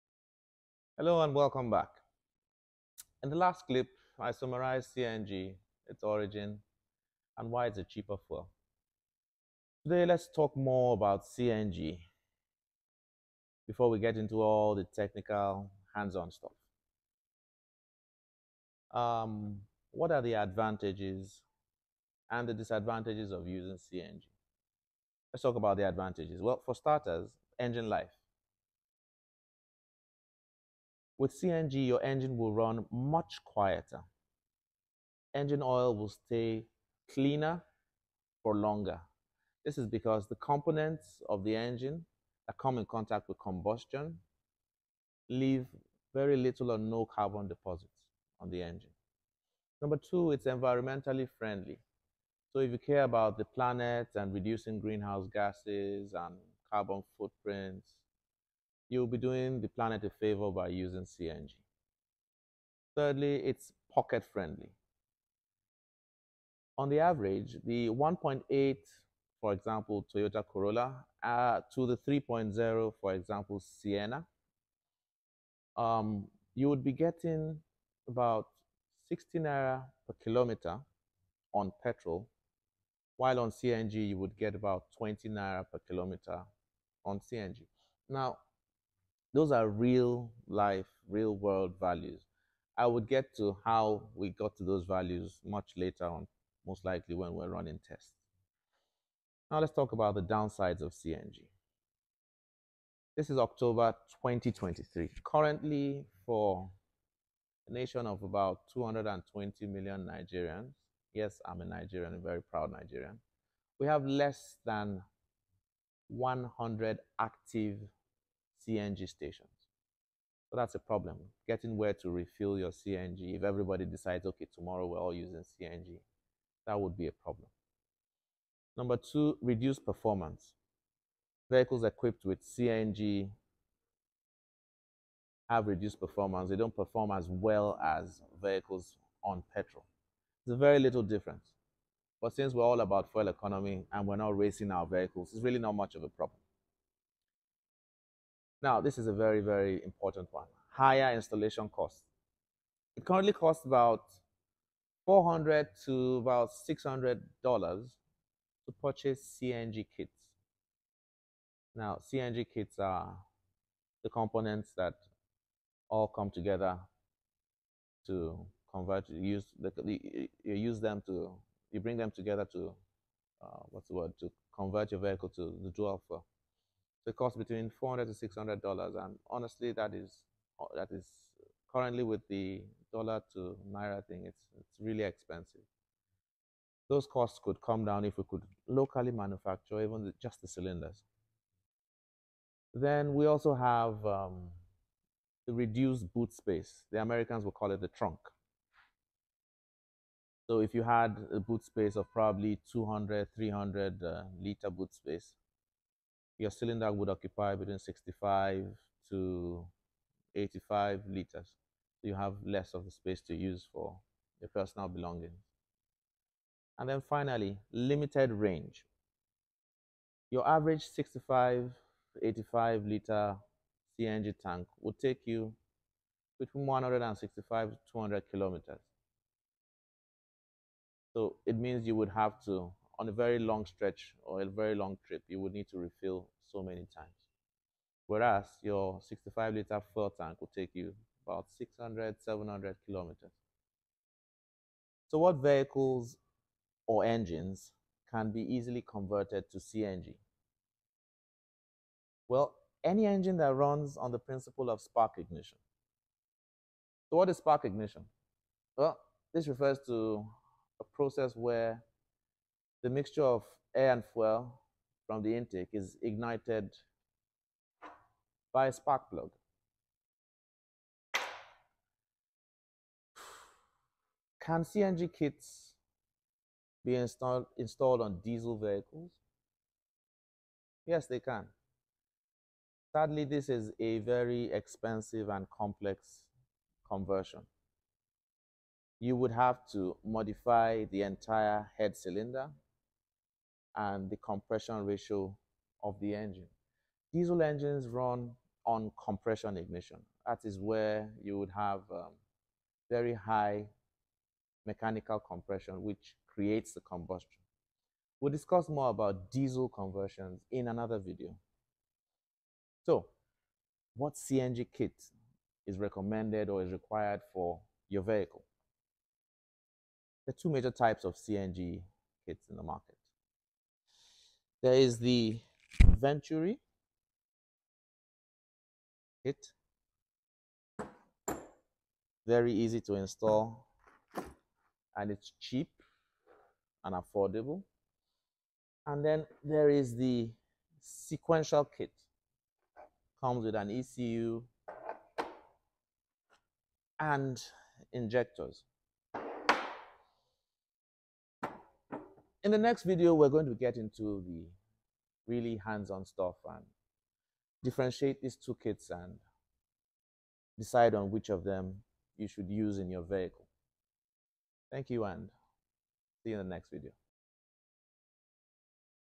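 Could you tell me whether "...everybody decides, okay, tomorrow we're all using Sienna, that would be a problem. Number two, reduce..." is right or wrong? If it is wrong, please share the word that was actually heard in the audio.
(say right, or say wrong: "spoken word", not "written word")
wrong: "CNG", not "Sienna".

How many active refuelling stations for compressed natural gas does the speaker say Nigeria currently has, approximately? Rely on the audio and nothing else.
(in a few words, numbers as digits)
less than 100.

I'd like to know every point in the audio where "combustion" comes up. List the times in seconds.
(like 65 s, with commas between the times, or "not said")
43 s, 306 s.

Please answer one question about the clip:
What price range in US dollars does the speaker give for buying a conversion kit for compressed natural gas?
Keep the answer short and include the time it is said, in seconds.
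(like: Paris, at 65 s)
400 to 600 dollars, at 155 s.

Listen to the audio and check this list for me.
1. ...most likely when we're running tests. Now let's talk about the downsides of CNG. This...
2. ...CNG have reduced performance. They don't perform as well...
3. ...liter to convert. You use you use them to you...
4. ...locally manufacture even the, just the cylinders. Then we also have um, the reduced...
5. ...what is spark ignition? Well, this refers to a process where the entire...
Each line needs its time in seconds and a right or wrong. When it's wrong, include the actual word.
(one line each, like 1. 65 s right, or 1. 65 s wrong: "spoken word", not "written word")
1. 96 s right
2. 132 s right
3. 166 s wrong: "together", not "liter"
4. 188 s right
5. 257 s wrong: "mixture", not "entire".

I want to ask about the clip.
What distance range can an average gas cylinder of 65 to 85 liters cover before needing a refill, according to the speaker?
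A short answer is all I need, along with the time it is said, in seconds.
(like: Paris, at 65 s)
165 to 200 kilometers, at 226 s.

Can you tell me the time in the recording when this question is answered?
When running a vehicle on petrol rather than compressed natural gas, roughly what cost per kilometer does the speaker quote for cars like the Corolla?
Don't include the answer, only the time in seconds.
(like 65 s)
79 s.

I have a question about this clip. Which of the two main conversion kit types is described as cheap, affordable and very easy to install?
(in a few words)
venturi kit.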